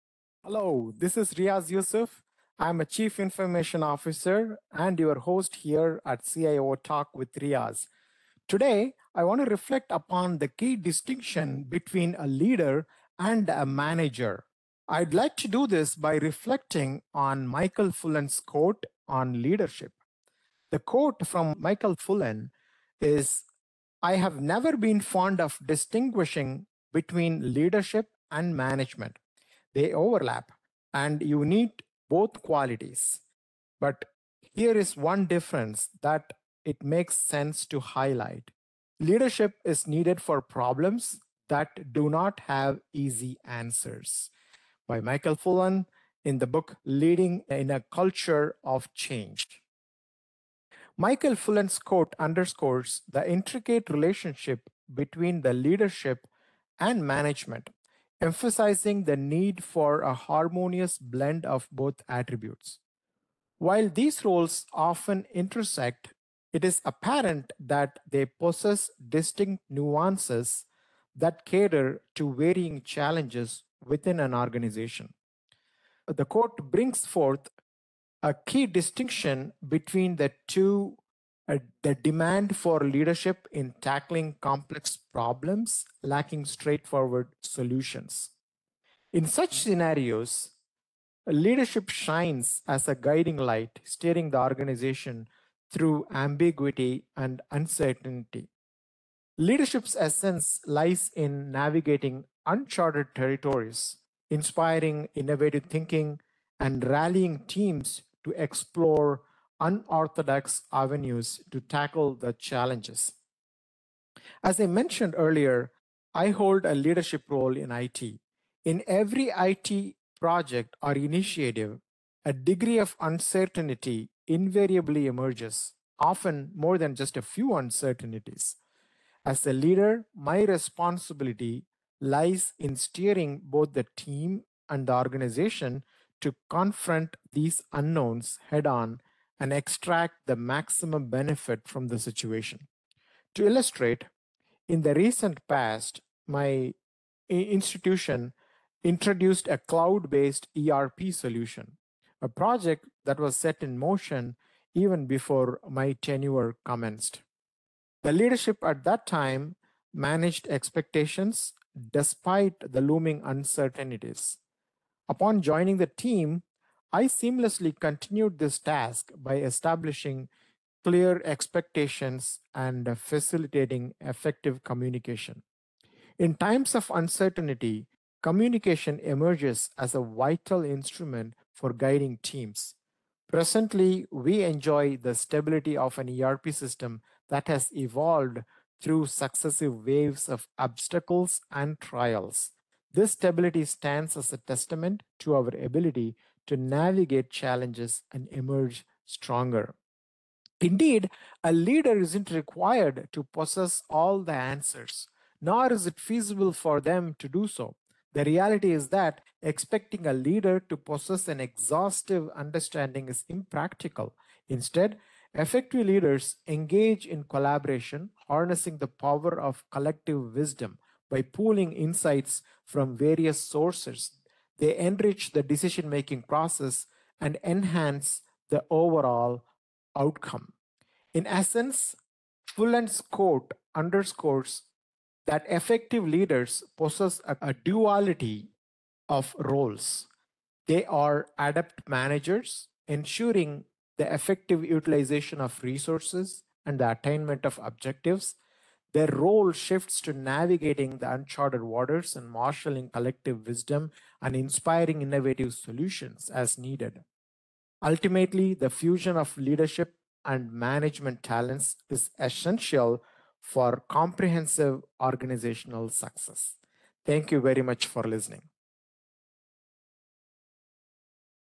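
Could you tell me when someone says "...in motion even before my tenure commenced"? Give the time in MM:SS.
02:33.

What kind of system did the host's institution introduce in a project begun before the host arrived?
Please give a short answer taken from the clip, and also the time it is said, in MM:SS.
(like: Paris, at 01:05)
Cloud-based ERP solution, at 02:29.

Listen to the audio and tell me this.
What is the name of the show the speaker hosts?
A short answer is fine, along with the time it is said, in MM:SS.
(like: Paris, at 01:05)
CIO Talk with Riaz, at 00:06.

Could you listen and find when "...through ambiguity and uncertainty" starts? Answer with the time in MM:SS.
01:35.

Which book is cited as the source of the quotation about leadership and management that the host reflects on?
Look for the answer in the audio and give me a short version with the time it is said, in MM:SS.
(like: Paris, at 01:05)
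Leading in a Culture of Change, at 00:46.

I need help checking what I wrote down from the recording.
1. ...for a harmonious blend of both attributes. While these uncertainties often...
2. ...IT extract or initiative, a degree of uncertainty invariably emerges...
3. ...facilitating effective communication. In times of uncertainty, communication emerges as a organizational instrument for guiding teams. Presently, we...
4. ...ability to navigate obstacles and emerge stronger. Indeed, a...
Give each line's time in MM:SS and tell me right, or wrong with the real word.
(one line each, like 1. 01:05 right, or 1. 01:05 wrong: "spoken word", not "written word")
1. 00:59 wrong: "roles", not "uncertainties"
2. 01:59 wrong: "project", not "extract"
3. 02:52 wrong: "vital", not "organizational"
4. 03:15 wrong: "challenges", not "obstacles".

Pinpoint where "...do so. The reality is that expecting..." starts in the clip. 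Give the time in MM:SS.
03:27.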